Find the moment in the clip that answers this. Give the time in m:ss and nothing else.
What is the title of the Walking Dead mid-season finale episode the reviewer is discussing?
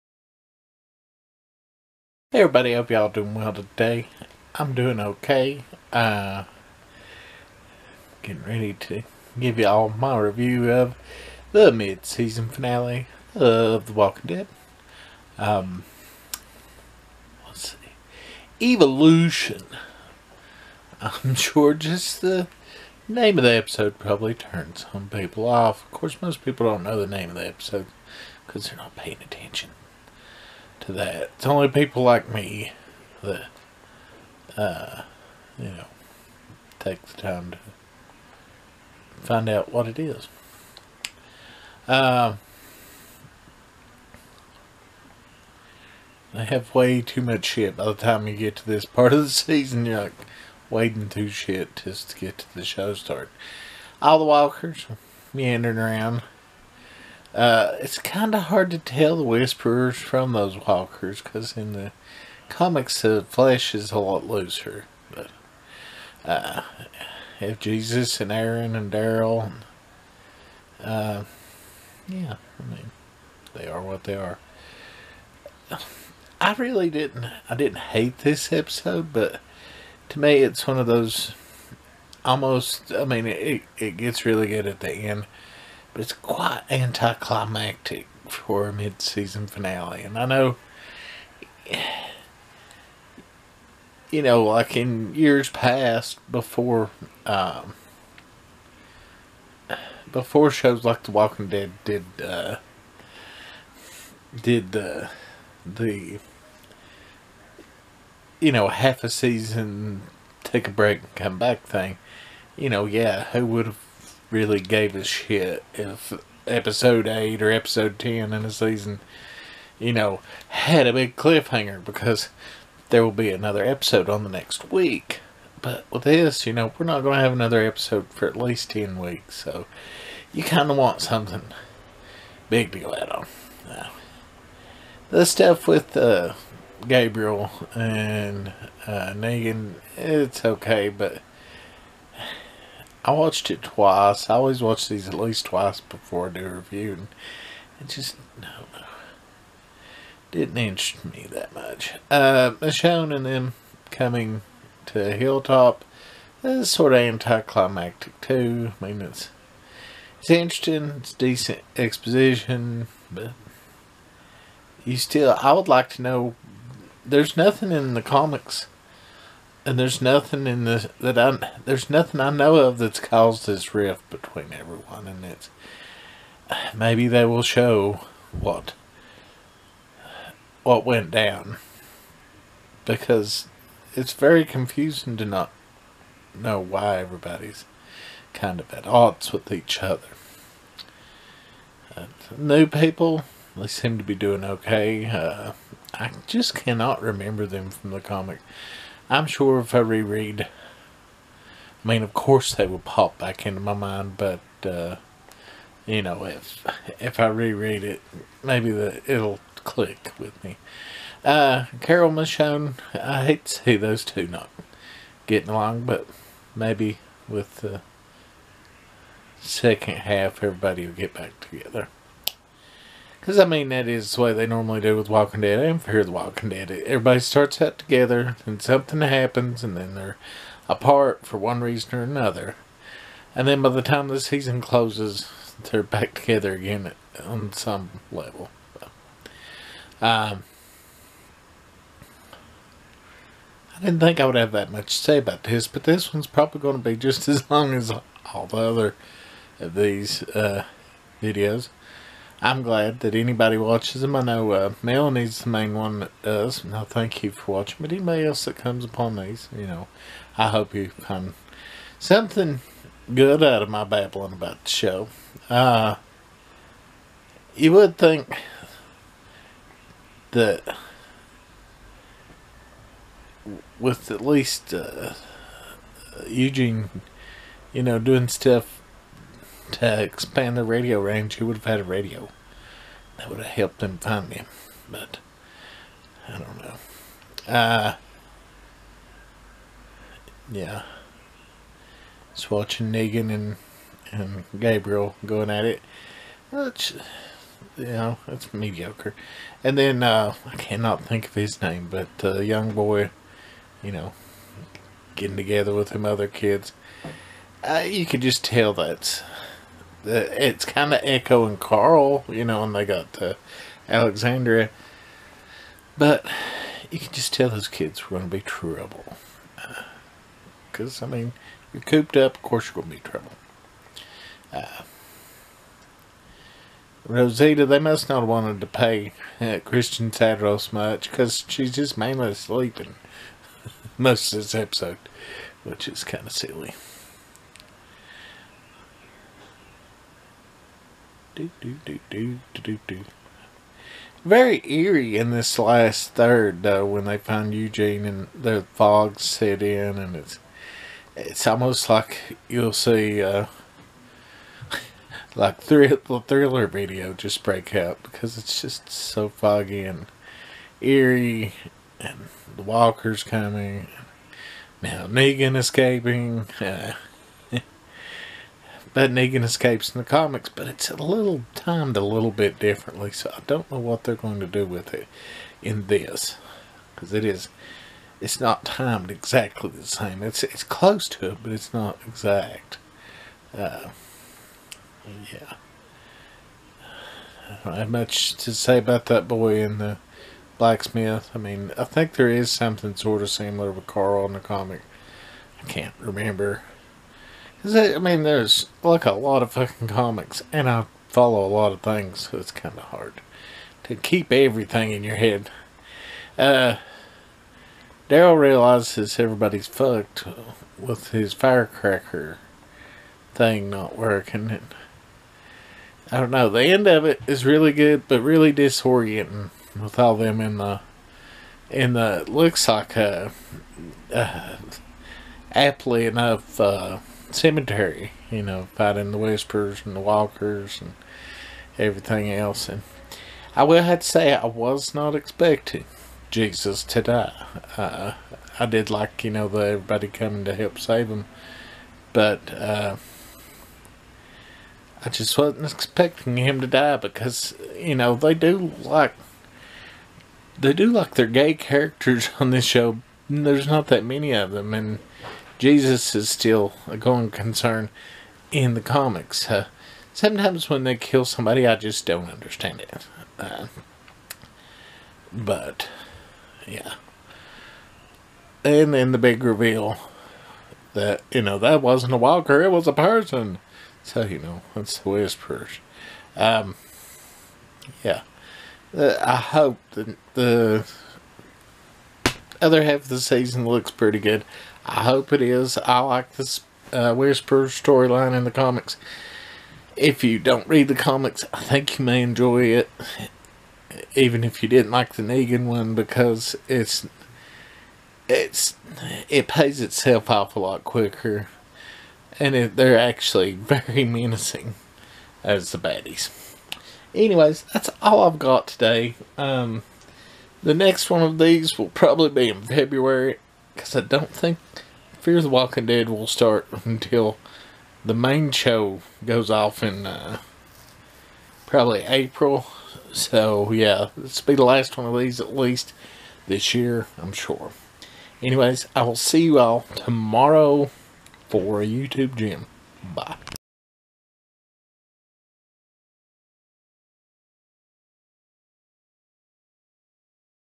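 0:18.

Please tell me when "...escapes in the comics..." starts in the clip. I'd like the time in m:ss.
6:09.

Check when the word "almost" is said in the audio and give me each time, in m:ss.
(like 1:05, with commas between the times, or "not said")
1:22, 5:51.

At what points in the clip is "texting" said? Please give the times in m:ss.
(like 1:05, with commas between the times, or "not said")
not said.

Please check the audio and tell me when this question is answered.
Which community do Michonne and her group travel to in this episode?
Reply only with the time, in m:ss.
2:35.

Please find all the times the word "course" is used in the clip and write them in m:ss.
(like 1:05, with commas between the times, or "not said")
0:25, 3:22, 5:22.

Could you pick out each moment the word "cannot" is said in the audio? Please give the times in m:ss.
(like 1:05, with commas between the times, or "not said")
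3:16, 5:00.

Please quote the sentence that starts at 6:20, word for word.
It's it's close to it, but it's not exact.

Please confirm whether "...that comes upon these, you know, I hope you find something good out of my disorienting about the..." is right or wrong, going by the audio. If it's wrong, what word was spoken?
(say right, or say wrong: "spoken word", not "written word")
wrong: "babbling", not "disorienting".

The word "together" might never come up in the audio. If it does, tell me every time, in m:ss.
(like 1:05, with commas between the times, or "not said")
3:41, 3:47, 3:56, 5:05.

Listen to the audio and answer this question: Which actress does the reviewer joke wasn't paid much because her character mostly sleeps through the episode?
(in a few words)
Christian Serratos.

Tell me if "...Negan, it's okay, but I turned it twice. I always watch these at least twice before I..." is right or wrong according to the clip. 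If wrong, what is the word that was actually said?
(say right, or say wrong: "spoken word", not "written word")
wrong: "watched", not "turned".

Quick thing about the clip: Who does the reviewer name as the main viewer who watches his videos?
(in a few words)
Melanie.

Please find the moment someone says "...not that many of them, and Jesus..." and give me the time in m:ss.
7:33.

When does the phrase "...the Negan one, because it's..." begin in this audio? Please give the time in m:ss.
8:15.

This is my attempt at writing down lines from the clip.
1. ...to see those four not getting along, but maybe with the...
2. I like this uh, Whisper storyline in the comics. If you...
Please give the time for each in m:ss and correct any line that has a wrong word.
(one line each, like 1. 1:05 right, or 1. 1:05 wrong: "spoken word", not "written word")
1. 3:33 wrong: "two", not "four"
2. 8:05 right.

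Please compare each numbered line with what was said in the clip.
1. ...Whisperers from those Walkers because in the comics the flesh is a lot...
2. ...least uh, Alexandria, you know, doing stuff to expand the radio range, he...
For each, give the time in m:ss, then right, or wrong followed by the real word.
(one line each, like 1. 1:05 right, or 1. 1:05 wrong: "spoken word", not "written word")
1. 0:59 right
2. 4:34 wrong: "Eugene", not "Alexandria".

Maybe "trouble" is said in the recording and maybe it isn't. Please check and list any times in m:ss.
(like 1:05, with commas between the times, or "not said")
5:18, 5:23.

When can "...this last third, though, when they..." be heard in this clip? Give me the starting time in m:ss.
5:45.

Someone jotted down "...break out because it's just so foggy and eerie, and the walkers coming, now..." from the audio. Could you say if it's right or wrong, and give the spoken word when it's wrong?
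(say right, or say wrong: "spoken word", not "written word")
right.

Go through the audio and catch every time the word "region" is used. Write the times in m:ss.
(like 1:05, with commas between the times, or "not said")
not said.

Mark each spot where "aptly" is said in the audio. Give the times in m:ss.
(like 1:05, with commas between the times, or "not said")
7:05.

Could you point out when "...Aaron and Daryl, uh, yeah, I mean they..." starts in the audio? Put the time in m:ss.
1:08.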